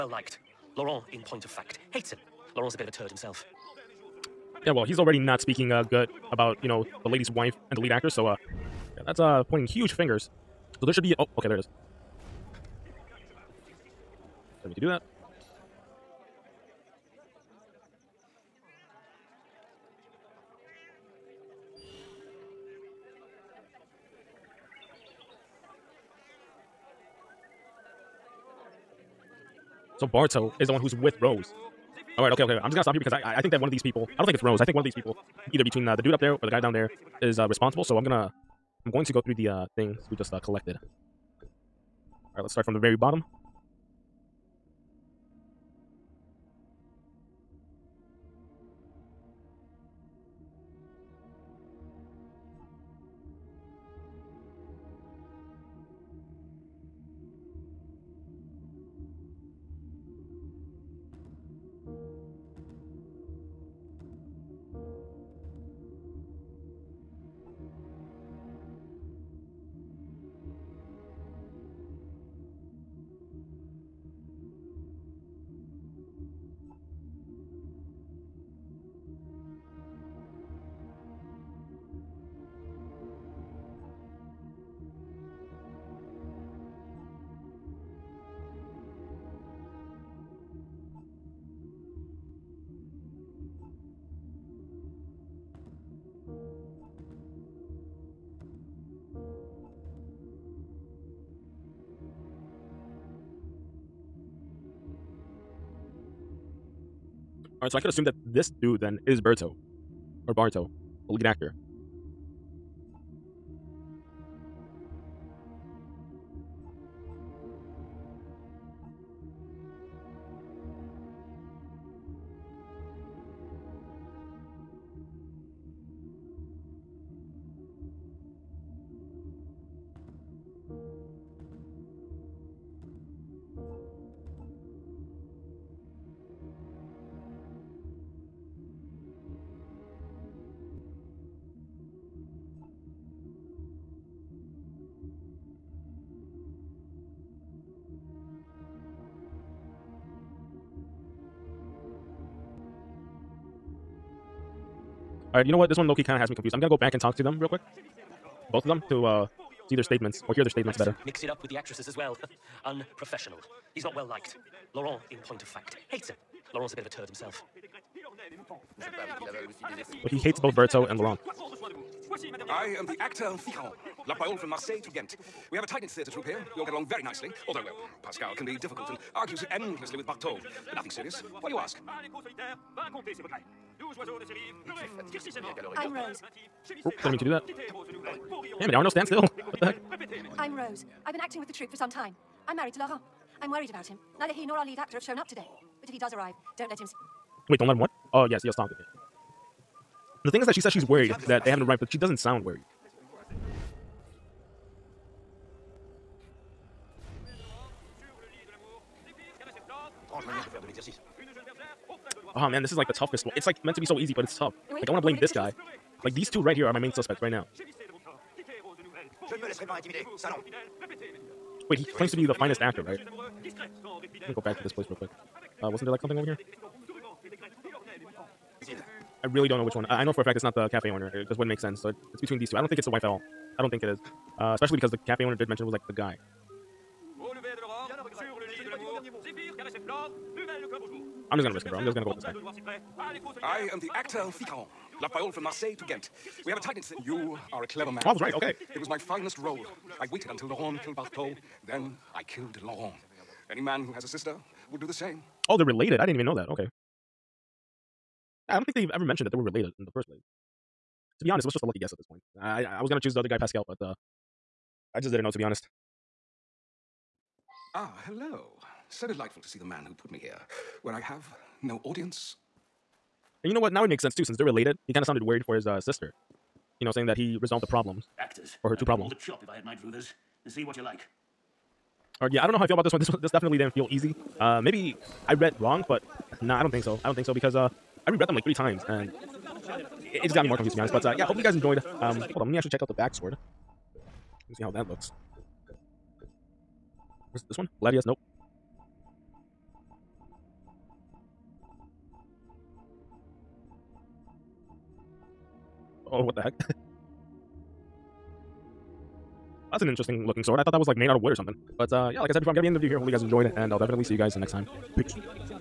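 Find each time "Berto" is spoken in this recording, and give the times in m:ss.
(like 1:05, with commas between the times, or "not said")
1:49, 2:50.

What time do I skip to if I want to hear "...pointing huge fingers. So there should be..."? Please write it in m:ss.
0:09.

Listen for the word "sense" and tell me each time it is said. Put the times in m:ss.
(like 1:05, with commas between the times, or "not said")
3:51, 4:34.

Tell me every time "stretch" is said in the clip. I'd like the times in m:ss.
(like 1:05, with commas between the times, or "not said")
not said.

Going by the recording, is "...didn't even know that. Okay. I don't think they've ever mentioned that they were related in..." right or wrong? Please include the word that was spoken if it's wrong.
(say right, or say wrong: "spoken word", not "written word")
right.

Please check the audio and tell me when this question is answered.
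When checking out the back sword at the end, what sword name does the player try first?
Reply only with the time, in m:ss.
4:57.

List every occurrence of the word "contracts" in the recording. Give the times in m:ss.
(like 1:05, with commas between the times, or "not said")
not said.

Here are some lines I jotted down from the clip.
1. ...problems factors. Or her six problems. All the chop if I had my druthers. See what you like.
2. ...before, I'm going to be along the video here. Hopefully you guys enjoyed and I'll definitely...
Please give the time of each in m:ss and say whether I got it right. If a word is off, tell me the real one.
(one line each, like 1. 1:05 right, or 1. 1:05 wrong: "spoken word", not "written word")
1. 4:37 wrong: "two", not "six"
2. 5:12 wrong: "ending", not "along".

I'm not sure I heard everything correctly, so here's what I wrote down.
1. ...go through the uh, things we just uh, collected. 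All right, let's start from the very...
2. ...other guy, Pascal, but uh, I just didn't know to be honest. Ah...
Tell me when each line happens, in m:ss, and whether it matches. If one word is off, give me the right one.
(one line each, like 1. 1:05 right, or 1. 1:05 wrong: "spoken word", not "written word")
1. 0:39 right
2. 4:23 right.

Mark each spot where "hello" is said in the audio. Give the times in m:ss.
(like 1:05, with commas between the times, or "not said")
4:28.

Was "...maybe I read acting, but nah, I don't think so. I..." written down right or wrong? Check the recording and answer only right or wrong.
wrong.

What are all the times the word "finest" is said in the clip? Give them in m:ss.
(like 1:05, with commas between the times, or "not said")
3:42, 4:08.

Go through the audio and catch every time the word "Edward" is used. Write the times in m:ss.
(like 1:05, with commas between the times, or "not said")
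not said.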